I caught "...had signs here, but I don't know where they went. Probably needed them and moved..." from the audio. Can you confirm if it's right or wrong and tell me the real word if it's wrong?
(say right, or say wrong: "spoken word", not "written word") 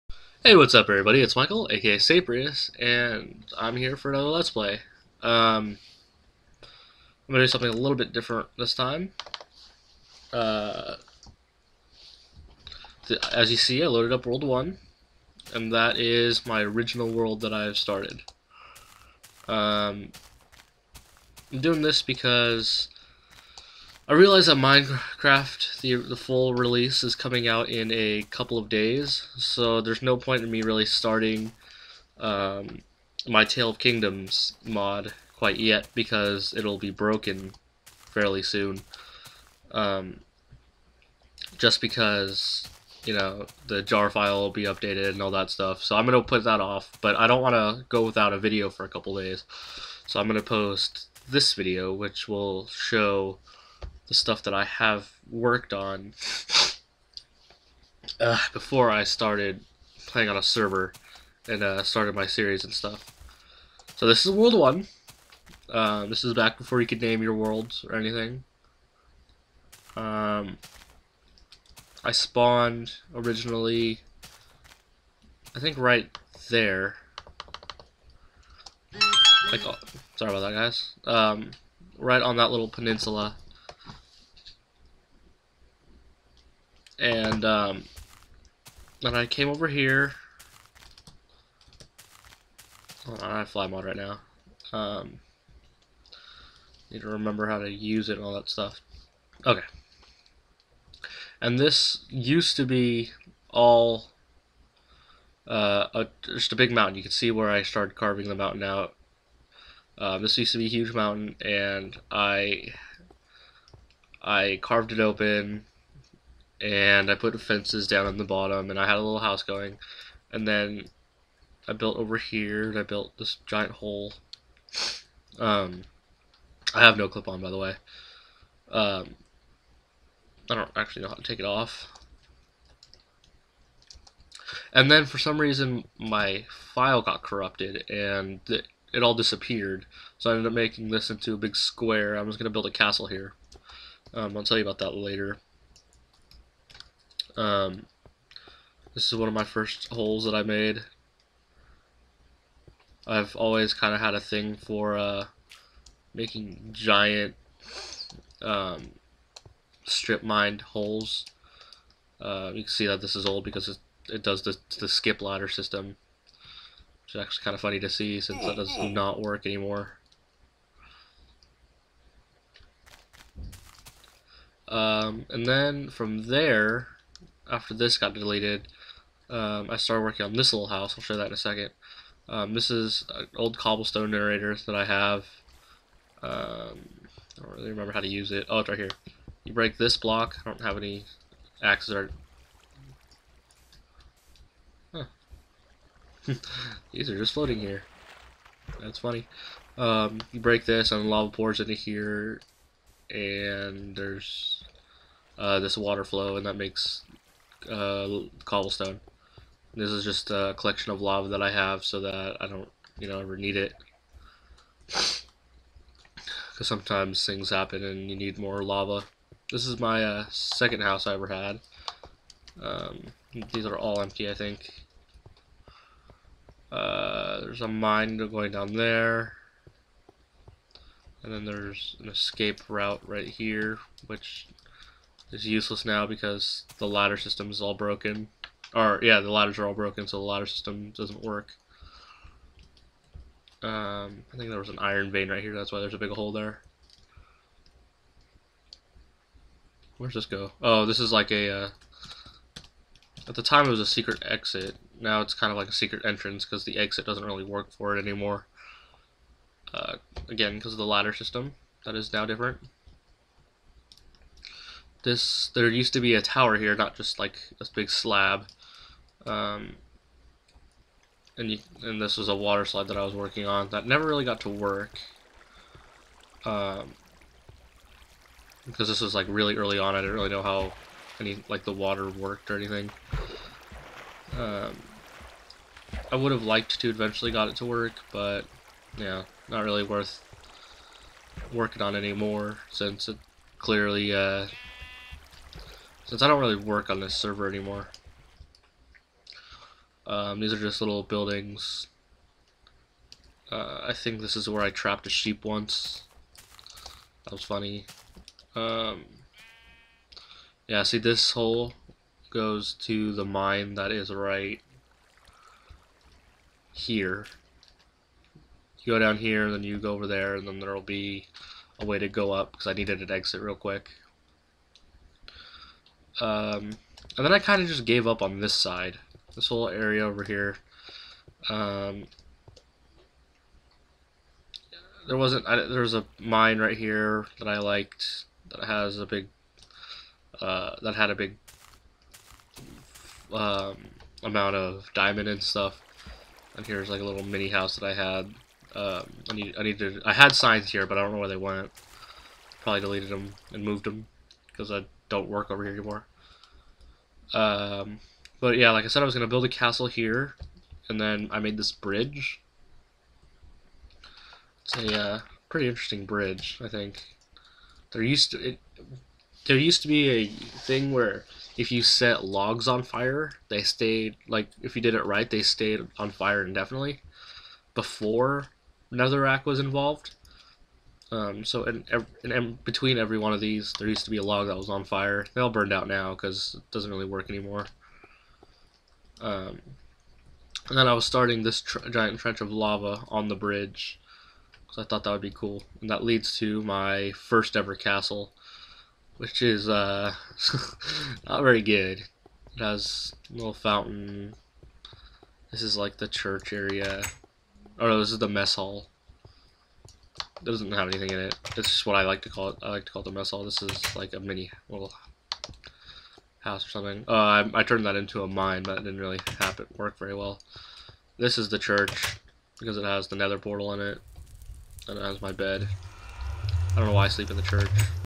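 wrong: "deleted", not "needed".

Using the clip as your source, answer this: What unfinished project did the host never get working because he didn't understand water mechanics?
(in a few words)
water slide.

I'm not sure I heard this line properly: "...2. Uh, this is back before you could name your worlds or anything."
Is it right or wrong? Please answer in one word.
wrong.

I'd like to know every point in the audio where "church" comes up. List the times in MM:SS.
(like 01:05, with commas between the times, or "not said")
06:46, 07:01, 07:07.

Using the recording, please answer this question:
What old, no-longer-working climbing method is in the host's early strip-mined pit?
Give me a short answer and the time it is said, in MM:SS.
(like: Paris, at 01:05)
skip ladder system, at 02:44.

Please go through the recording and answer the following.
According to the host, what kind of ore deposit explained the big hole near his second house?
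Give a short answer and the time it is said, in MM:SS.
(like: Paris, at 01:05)
iron vein, at 04:04.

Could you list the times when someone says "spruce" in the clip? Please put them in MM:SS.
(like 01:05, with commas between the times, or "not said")
not said.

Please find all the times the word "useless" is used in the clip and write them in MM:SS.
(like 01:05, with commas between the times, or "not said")
03:55.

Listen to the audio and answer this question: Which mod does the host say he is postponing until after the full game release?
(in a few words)
Tale of Kingdoms.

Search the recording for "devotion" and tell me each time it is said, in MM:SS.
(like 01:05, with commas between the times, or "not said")
not said.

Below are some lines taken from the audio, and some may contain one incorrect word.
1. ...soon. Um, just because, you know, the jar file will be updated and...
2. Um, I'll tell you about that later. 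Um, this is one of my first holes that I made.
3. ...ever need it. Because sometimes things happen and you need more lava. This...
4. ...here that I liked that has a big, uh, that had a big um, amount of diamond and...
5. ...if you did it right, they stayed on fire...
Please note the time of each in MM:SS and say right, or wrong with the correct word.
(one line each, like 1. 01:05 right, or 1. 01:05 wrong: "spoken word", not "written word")
1. 00:38 right
2. 02:24 right
3. 03:33 right
4. 05:36 right
5. 06:14 right.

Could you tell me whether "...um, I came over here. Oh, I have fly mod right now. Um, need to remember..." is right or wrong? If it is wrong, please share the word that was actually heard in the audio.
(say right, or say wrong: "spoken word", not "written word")
right.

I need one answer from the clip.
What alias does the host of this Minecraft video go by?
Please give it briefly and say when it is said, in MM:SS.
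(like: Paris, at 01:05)
Saprious, at 00:01.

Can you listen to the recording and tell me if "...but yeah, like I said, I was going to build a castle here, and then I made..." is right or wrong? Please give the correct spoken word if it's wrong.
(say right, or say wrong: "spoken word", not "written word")
right.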